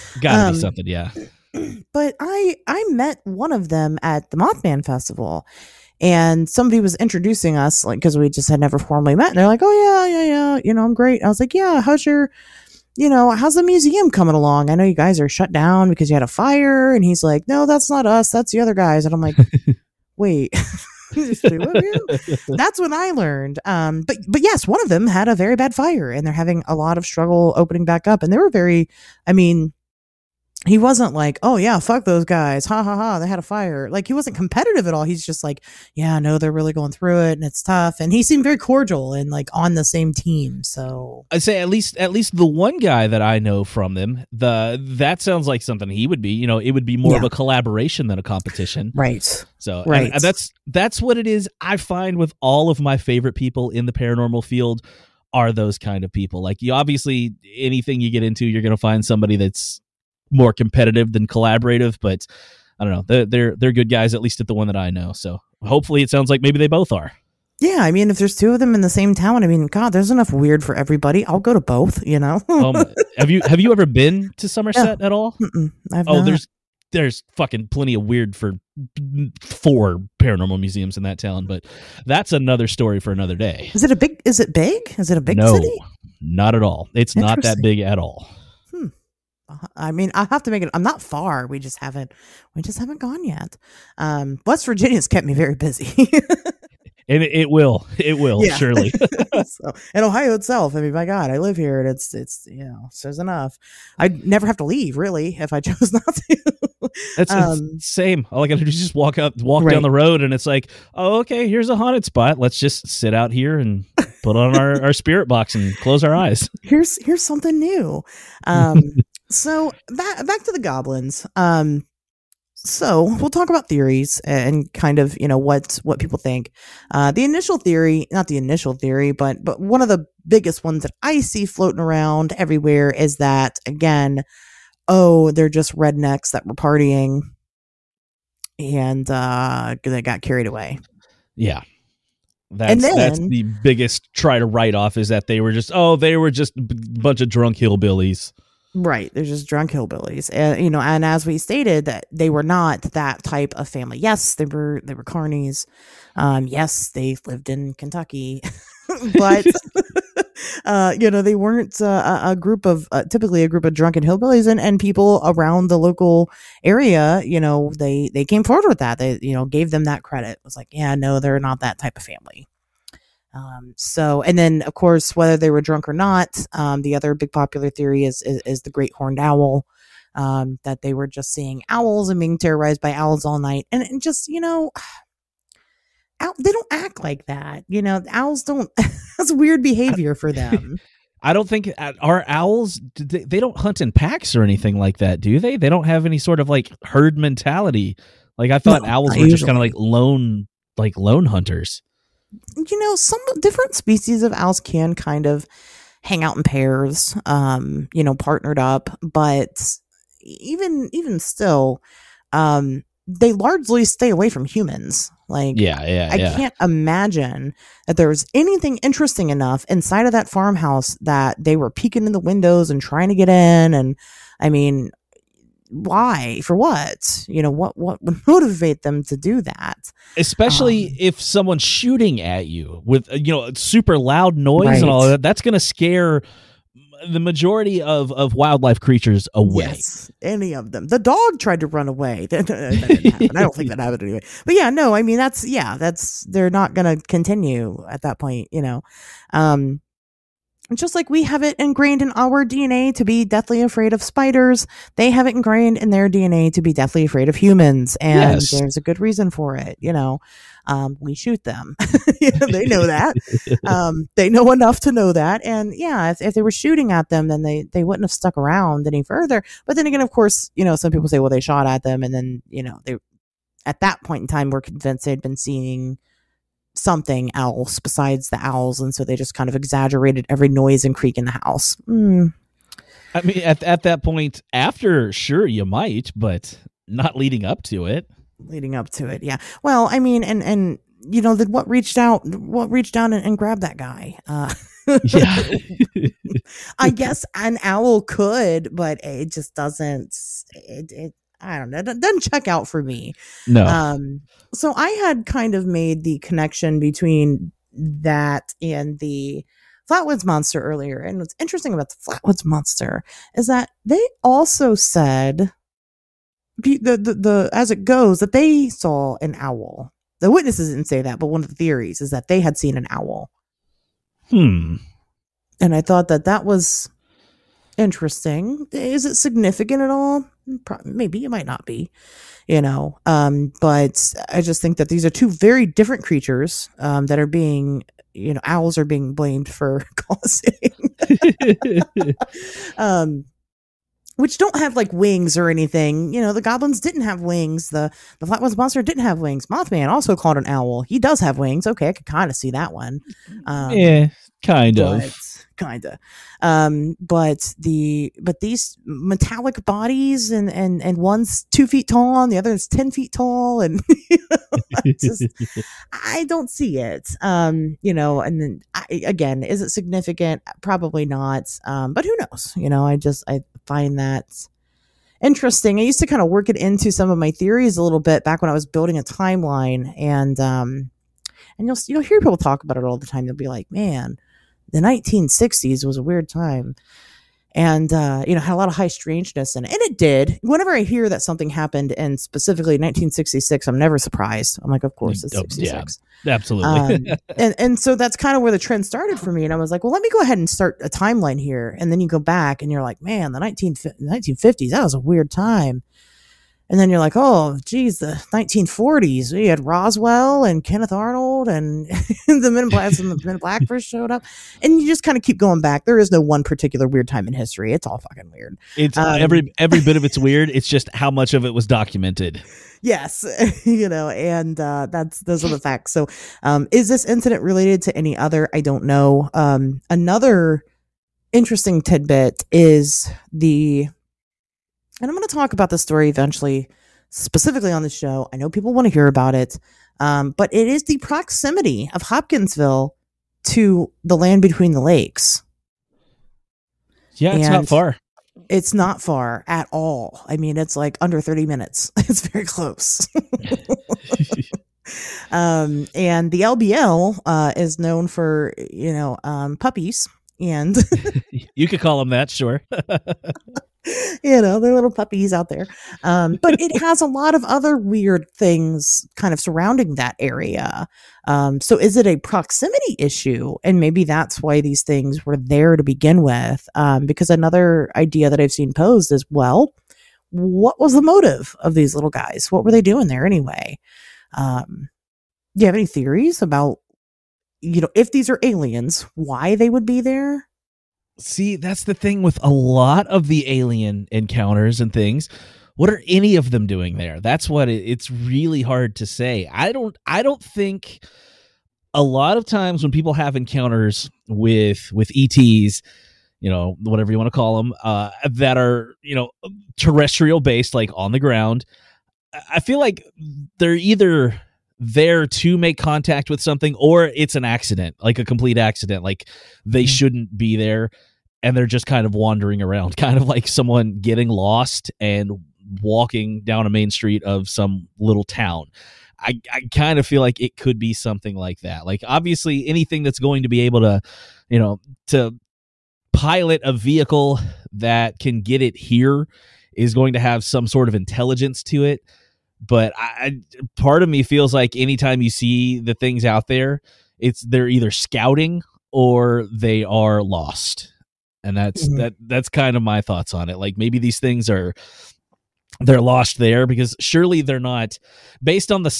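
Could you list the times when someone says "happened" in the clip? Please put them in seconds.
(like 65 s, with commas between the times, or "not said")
243 s, 391 s.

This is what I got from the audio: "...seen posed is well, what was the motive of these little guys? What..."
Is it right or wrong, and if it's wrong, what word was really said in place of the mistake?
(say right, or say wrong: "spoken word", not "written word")
right.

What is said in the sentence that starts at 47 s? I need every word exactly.
of a collaboration than a competition, right?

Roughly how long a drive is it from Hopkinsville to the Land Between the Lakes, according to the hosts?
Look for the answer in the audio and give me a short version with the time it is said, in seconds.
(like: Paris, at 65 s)
Under 30 minutes, at 451 s.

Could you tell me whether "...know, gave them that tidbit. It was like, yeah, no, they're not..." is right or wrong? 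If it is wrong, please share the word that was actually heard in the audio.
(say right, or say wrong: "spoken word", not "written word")
wrong: "credit", not "tidbit".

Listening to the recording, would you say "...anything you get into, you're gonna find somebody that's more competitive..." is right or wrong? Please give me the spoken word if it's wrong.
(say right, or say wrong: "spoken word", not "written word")
right.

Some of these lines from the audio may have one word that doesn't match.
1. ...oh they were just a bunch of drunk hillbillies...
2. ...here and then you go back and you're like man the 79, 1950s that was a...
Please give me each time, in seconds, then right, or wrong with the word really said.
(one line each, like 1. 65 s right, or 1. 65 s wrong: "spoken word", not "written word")
1. 145 s right
2. 401 s wrong: "19", not "79".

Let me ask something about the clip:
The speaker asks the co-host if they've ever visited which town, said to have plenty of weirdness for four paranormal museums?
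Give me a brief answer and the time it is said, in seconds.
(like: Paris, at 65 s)
Somerset, at 74 s.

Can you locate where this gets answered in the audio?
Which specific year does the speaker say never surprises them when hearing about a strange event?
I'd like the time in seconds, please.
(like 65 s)
395 s.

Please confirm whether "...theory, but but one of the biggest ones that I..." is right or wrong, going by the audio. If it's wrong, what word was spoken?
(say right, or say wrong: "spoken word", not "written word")
right.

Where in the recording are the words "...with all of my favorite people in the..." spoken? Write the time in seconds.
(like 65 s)
52 s.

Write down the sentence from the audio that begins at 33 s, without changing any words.
Like he wasn't competitive at all.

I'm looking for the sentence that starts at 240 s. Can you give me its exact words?
The dog tried to run away.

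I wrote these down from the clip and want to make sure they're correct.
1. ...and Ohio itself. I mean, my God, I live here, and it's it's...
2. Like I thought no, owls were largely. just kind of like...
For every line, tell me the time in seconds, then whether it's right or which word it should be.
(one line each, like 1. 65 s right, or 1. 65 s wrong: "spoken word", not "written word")
1. 99 s right
2. 198 s wrong: "usually", not "largely".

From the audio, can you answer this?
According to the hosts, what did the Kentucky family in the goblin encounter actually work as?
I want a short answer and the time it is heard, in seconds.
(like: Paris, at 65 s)
Carnies, at 155 s.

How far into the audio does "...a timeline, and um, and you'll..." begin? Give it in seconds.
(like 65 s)
378 s.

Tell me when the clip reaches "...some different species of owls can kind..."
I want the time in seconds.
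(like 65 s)
202 s.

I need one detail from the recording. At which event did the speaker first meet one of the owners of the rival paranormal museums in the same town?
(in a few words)
Mothman Festival.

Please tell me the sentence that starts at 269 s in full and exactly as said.
But then again, of course, you know, some people say, well, they shot at them.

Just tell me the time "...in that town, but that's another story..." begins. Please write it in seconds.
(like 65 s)
80 s.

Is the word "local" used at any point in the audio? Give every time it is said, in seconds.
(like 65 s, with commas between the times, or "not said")
165 s.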